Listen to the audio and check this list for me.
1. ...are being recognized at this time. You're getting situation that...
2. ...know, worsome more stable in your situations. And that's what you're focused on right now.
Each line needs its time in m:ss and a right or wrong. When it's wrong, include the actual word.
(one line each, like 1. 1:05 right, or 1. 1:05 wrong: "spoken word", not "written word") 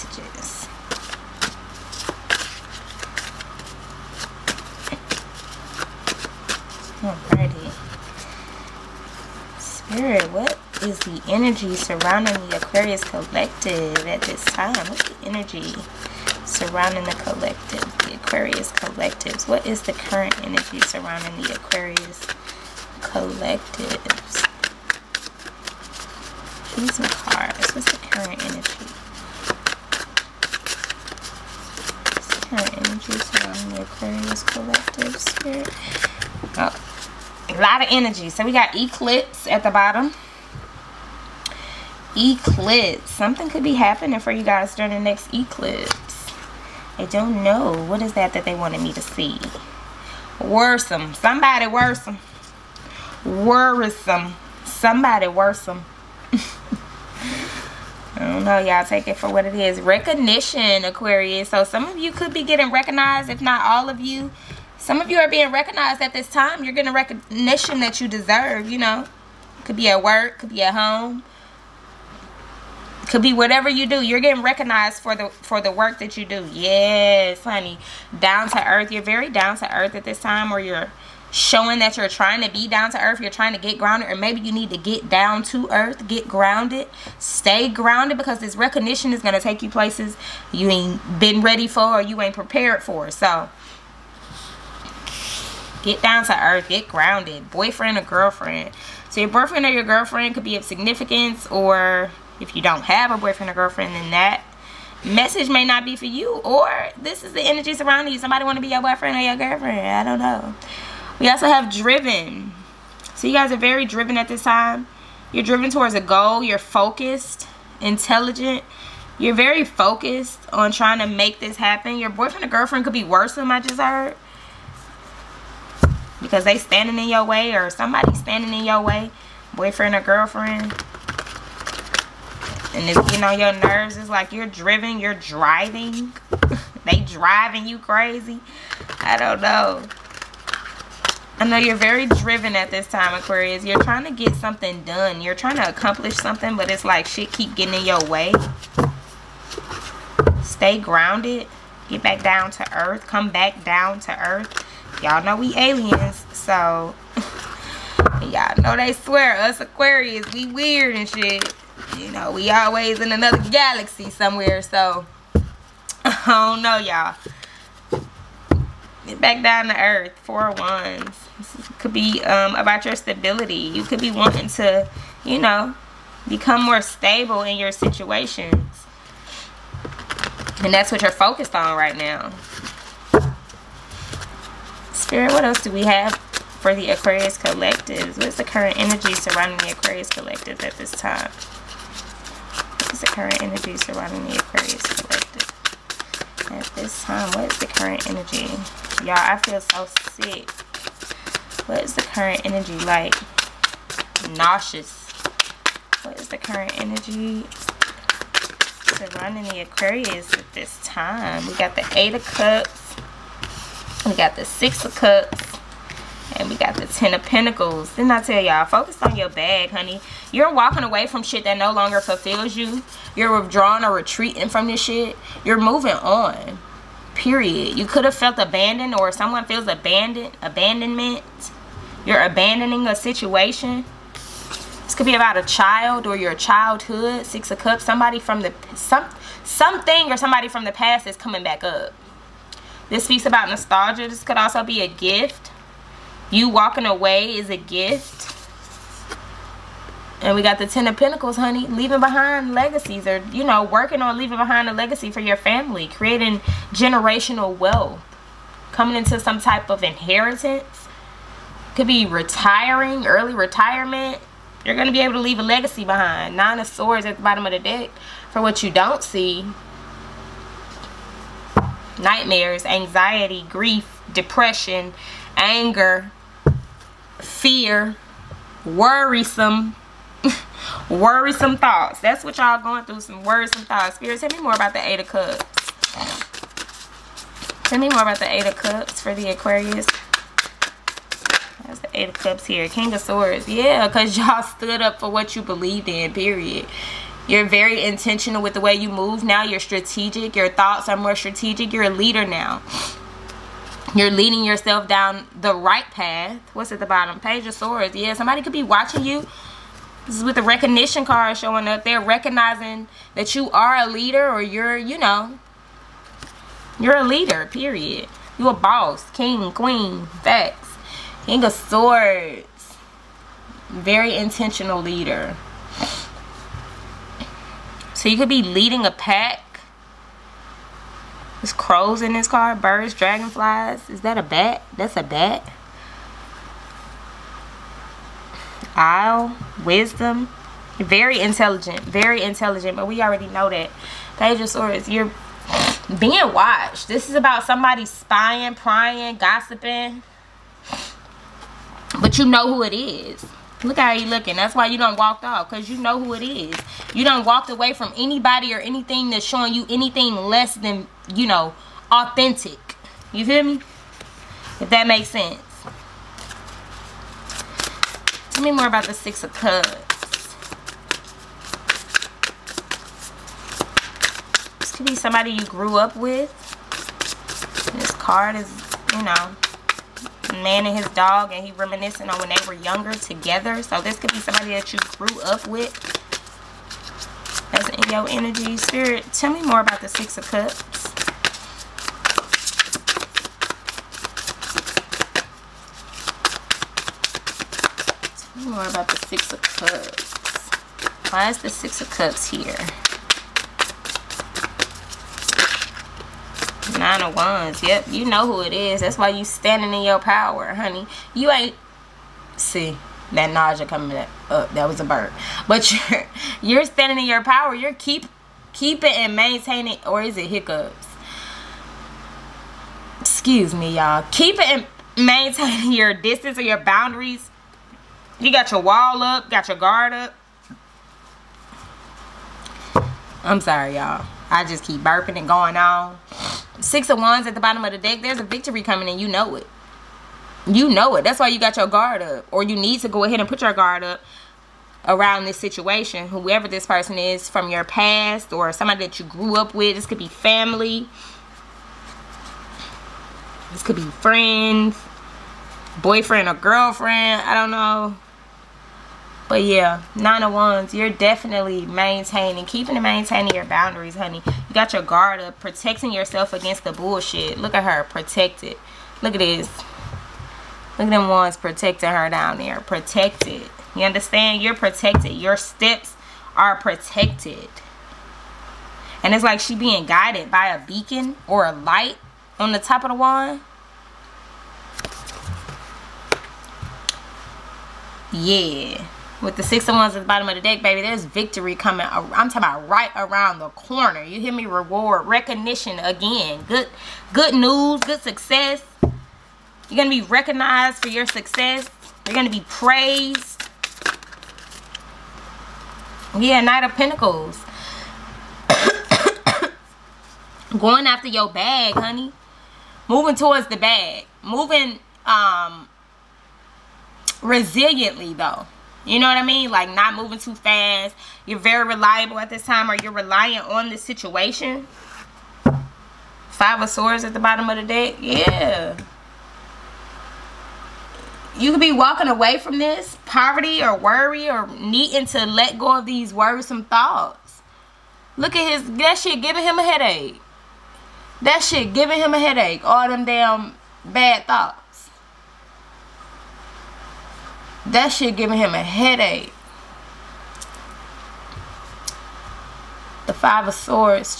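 1. 1:05 wrong: "recognition", not "situation"
2. 2:55 wrong: "become", not "worsome".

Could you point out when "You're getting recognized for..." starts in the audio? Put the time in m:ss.
1:14.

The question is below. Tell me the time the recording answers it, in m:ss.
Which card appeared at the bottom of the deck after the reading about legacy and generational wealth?
4:26.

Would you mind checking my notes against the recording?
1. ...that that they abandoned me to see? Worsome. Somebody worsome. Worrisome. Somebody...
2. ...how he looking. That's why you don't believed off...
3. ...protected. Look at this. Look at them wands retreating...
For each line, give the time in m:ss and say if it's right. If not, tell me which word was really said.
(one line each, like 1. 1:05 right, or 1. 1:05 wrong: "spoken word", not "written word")
1. 0:48 wrong: "wanted", not "abandoned"
2. 5:53 wrong: "walked", not "believed"
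3. 7:47 wrong: "protecting", not "retreating".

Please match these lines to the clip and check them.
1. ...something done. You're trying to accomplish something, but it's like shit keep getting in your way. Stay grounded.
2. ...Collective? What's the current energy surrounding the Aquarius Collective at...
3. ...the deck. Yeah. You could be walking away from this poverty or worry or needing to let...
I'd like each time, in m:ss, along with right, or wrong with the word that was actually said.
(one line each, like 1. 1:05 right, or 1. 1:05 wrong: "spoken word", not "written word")
1. 2:24 right
2. 3:07 right
3. 8:47 right.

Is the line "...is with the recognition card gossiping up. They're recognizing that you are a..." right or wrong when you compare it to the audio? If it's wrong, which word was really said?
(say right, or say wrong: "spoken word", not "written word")
wrong: "showing", not "gossiping".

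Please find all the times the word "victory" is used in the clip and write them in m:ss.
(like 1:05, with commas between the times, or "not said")
7:18, 8:11.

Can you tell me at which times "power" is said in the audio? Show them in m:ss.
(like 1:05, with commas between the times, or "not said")
6:49, 6:57.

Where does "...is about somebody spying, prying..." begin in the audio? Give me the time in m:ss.
5:47.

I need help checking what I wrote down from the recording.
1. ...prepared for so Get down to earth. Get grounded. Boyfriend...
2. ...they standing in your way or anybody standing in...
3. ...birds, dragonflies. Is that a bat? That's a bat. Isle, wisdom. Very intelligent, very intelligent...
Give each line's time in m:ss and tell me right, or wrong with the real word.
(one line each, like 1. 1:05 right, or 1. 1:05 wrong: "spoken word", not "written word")
1. 1:32 right
2. 2:06 wrong: "somebody", not "anybody"
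3. 5:32 right.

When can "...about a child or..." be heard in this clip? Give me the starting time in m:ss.
3:55.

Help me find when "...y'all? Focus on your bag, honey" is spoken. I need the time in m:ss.
3:38.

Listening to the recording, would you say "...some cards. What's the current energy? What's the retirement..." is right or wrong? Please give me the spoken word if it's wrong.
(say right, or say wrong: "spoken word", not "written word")
wrong: "current", not "retirement".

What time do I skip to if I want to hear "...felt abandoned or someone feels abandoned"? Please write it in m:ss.
3:48.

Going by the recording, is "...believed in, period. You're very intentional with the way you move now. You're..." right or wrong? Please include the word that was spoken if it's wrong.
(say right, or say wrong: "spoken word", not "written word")
right.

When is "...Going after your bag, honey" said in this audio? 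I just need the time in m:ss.
8:30.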